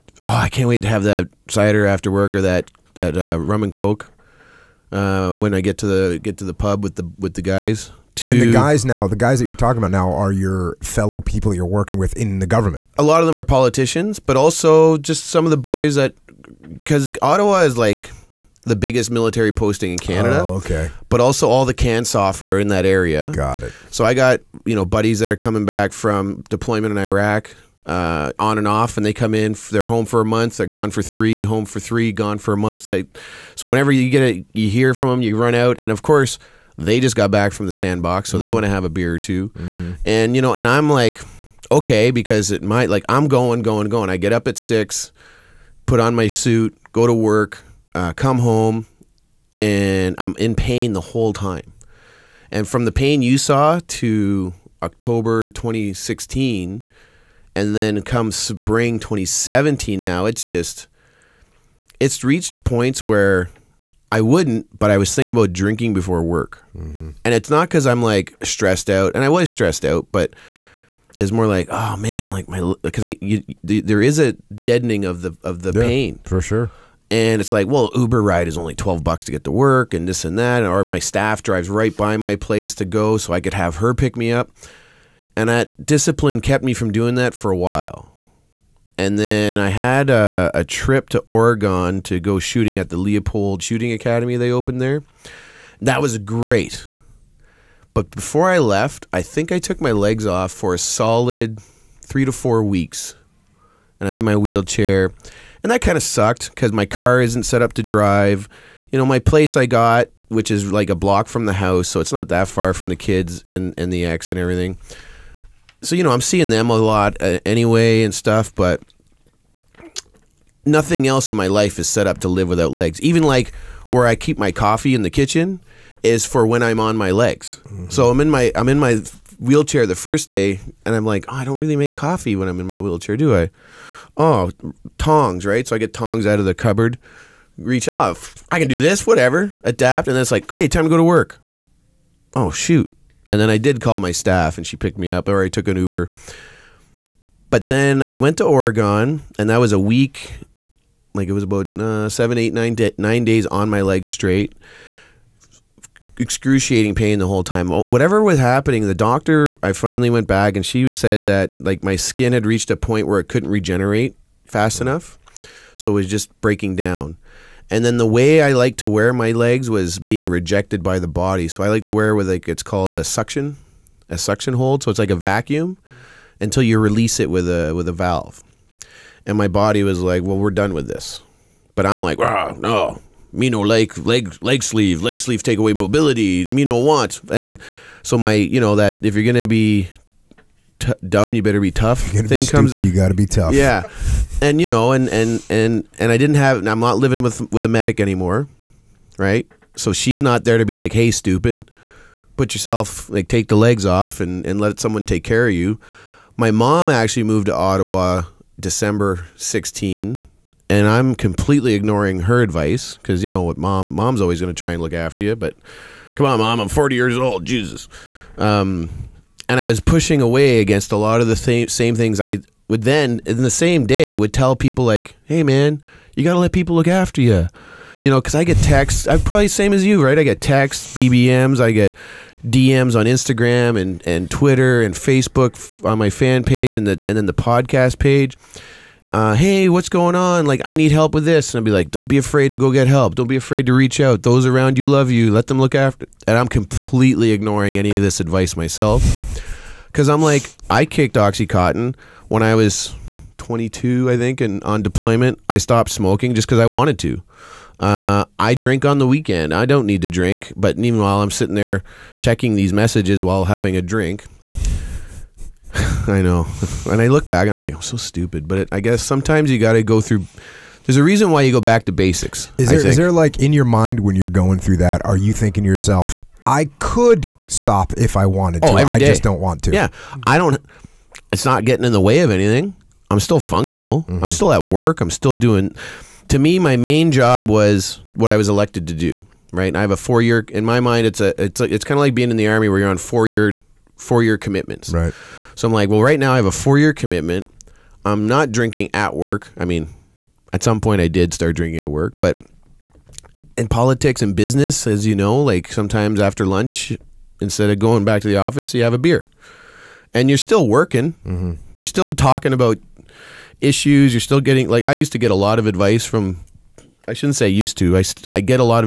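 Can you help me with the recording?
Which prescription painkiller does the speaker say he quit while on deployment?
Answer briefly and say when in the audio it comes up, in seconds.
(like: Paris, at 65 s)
Oxycontin, at 251 s.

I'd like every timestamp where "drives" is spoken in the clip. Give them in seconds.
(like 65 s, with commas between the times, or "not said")
81 s, 107 s.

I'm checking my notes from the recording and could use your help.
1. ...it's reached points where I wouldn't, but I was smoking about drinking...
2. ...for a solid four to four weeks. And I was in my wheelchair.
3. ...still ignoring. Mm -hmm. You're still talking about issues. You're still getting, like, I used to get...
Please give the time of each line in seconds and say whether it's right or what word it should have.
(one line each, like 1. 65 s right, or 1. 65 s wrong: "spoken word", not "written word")
1. 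61 s wrong: "thinking", not "smoking"
2. 100 s wrong: "three", not "four"
3. 310 s wrong: "working", not "ignoring".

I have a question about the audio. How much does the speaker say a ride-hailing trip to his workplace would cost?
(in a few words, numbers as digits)
$12.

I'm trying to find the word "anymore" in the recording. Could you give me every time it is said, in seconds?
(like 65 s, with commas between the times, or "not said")
197 s.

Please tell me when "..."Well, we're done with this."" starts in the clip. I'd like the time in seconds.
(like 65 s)
180 s.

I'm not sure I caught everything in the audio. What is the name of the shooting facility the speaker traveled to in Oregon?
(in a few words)
Leupold Shooting Academy.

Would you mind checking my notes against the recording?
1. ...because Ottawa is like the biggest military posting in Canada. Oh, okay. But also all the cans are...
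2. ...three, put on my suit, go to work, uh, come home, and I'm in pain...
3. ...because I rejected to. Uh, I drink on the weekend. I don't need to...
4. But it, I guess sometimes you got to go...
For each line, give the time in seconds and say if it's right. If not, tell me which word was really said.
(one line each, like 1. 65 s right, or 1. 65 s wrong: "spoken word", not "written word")
1. 16 s right
2. 44 s wrong: "six", not "three"
3. 256 s wrong: "wanted", not "rejected"
4. 268 s right.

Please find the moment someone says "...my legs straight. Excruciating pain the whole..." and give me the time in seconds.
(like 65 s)
153 s.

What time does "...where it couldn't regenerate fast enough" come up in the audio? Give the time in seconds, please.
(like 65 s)
163 s.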